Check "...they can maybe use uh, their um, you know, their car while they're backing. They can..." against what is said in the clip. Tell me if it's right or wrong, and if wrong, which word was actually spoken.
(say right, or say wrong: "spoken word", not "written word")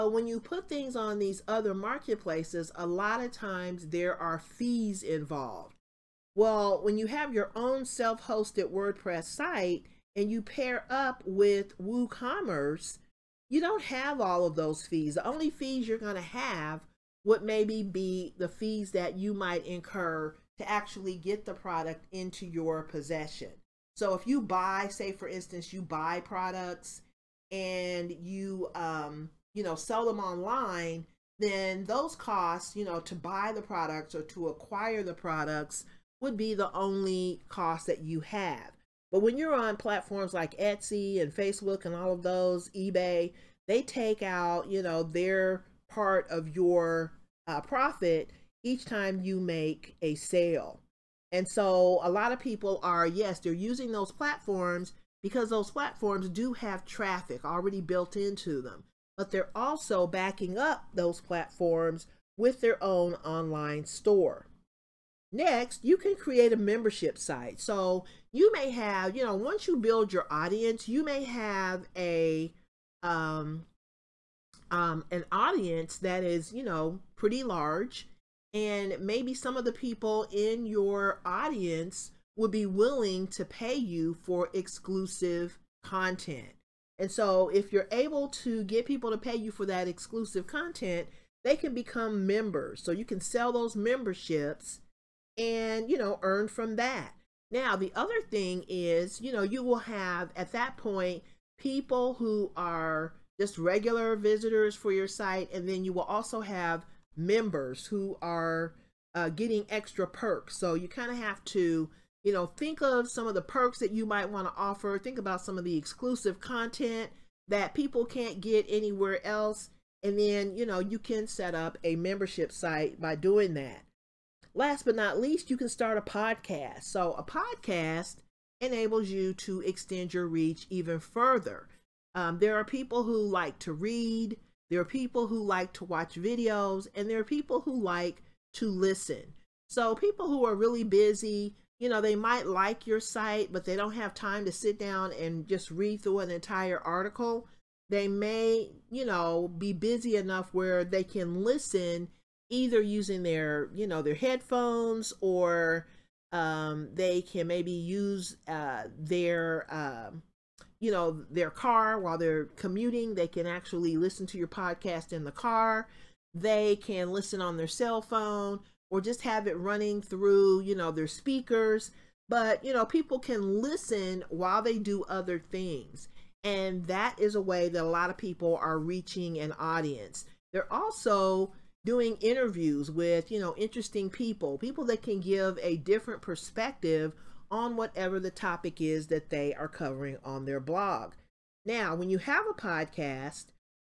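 wrong: "commuting", not "backing".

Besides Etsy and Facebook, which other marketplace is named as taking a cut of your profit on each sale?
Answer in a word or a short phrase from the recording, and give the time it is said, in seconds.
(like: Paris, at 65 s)
eBay, at 42 s.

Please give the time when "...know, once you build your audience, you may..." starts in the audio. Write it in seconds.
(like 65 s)
69 s.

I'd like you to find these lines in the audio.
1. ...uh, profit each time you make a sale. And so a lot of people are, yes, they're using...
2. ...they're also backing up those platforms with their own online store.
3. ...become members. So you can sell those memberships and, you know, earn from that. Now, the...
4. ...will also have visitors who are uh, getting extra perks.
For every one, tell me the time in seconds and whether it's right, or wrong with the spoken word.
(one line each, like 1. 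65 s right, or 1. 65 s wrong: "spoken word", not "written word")
1. 47 s right
2. 59 s right
3. 91 s right
4. 105 s wrong: "members", not "visitors".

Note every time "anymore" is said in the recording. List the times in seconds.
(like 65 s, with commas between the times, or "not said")
not said.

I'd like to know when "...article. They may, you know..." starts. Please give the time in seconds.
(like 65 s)
146 s.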